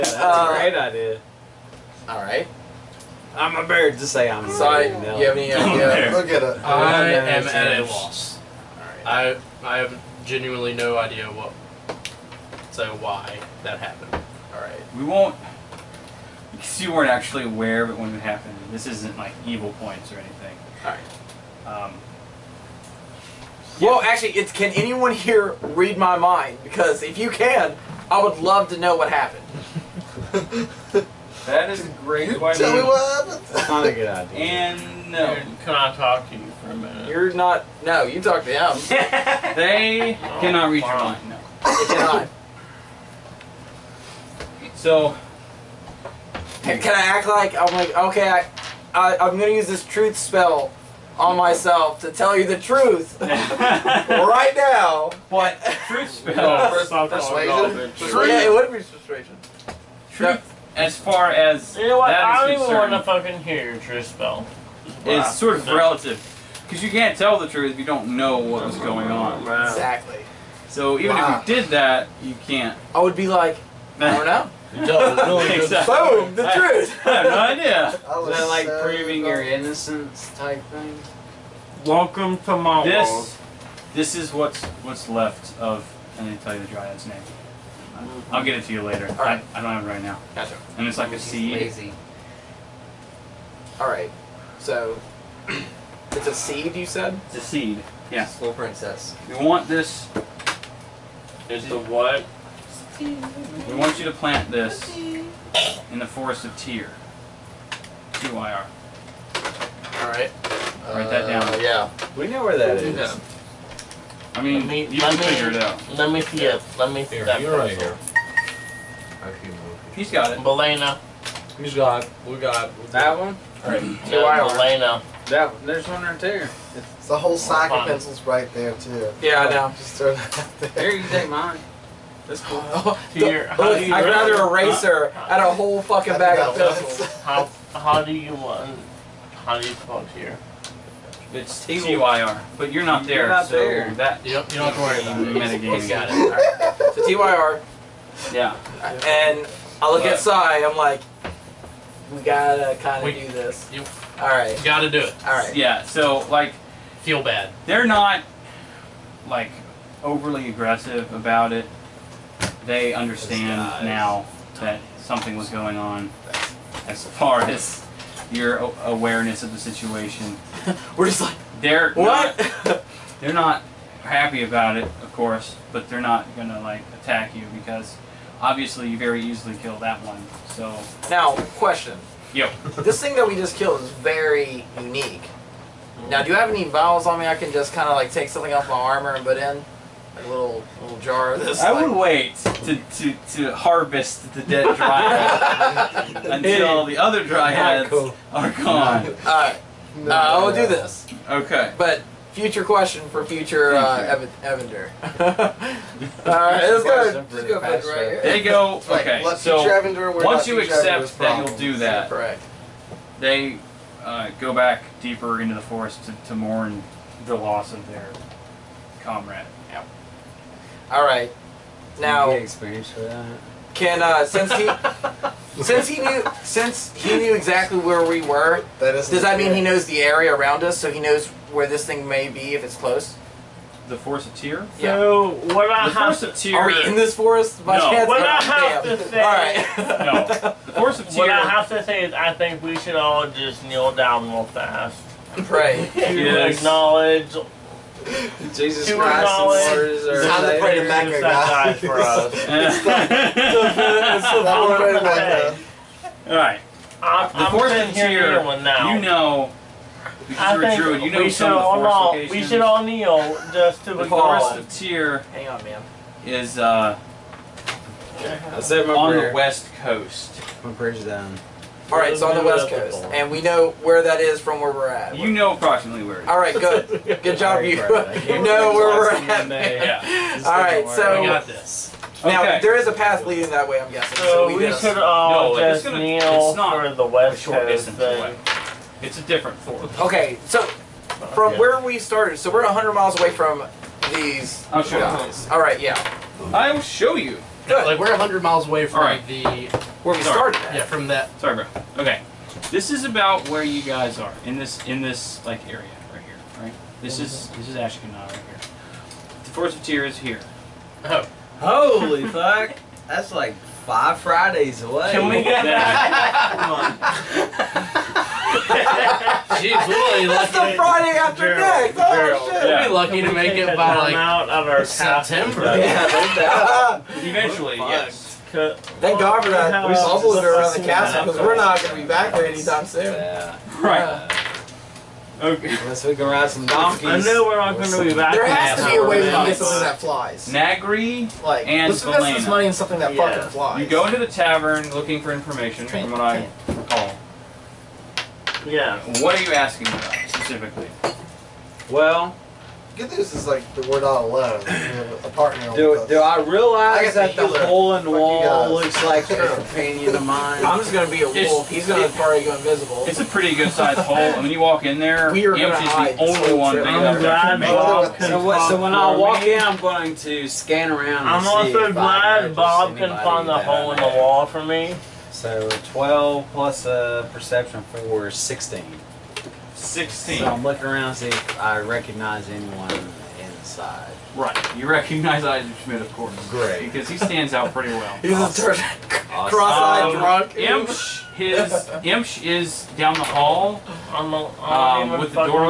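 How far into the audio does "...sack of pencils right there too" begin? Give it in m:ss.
2:07.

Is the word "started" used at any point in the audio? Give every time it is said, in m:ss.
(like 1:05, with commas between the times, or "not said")
4:51, 5:00.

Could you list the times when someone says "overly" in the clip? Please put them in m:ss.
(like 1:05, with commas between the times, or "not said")
2:40.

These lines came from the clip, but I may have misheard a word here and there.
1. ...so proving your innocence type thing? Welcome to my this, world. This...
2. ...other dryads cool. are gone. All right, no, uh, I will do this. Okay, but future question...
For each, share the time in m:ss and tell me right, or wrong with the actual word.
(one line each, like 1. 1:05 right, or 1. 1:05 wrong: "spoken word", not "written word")
1. 1:18 right
2. 3:16 right.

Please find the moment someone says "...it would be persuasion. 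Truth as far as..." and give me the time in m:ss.
0:58.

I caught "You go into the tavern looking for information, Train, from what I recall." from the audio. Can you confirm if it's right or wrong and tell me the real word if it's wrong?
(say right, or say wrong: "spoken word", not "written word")
right.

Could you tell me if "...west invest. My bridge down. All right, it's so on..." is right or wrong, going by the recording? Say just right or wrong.
wrong.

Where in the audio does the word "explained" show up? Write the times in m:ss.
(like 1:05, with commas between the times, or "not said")
not said.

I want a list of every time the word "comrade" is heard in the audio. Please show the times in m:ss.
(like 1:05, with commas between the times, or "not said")
3:39.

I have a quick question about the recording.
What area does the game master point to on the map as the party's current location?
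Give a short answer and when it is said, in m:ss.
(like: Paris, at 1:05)
Ashkenaz, at 5:07.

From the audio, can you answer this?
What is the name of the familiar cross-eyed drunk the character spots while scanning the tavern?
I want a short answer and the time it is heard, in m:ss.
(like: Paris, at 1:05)
Isaac Schmidt, at 6:25.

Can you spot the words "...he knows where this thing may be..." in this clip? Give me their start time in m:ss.
3:50.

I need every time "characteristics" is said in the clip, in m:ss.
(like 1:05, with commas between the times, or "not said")
not said.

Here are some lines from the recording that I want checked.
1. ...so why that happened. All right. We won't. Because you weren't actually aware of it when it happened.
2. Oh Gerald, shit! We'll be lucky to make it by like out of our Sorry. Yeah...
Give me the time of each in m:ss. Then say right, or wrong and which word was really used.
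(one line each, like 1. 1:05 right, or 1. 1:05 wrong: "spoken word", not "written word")
1. 0:12 right
2. 5:21 wrong: "September", not "Sorry".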